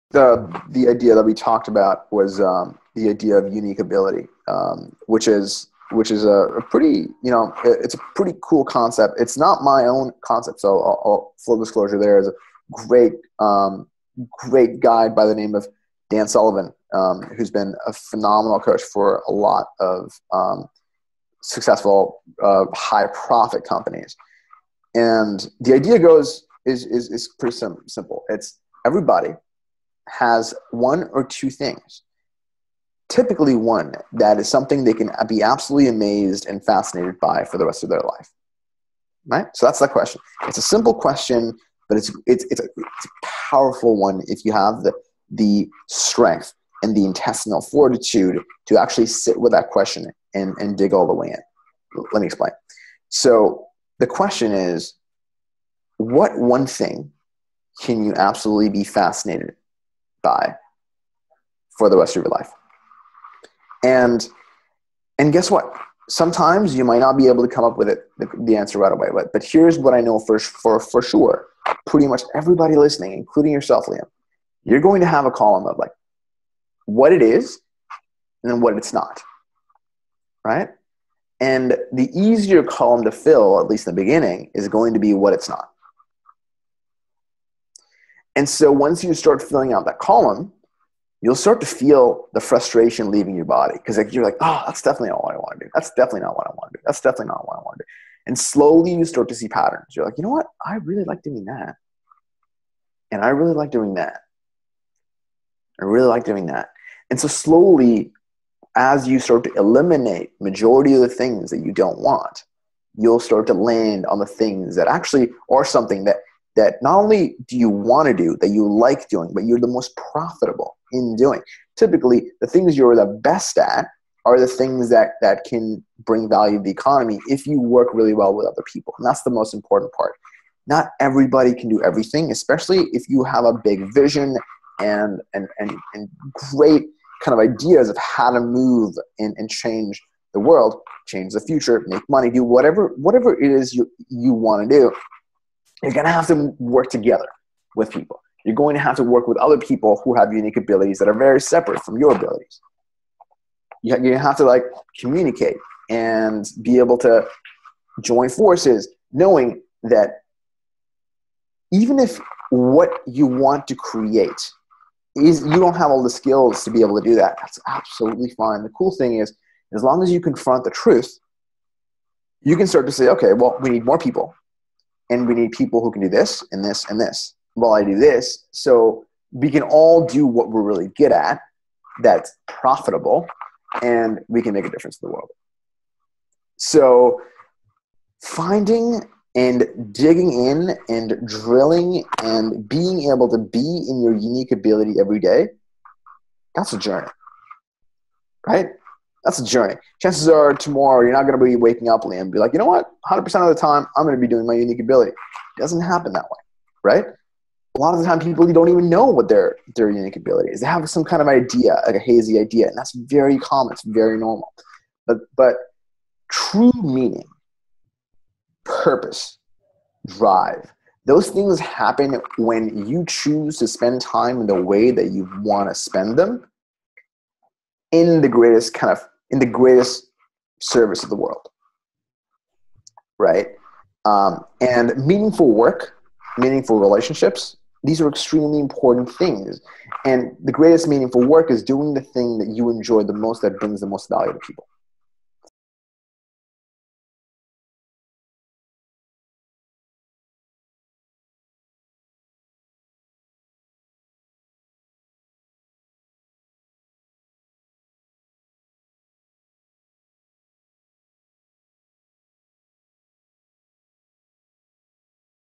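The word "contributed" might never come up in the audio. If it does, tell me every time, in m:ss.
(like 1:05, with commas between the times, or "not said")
not said.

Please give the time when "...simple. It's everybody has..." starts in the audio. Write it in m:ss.
0:27.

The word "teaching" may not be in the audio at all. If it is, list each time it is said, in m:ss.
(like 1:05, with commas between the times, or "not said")
not said.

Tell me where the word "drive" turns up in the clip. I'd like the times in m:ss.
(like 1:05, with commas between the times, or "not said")
3:40.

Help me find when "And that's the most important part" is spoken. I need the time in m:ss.
2:08.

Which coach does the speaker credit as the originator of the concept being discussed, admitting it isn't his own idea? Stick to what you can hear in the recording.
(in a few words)
Dan Sullivan.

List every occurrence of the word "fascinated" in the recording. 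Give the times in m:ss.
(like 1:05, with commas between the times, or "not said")
0:36, 0:58.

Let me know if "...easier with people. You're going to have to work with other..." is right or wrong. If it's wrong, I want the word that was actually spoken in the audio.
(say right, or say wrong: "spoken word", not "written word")
wrong: "together", not "easier".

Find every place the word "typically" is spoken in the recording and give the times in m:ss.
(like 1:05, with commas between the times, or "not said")
0:33, 2:01.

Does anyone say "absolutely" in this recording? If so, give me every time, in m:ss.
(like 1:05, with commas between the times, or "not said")
0:35, 0:58, 2:47.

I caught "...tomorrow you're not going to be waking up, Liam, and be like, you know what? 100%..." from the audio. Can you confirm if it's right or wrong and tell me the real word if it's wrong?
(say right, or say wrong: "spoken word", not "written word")
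right.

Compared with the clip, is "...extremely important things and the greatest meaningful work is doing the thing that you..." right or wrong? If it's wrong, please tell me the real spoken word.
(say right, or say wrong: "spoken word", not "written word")
right.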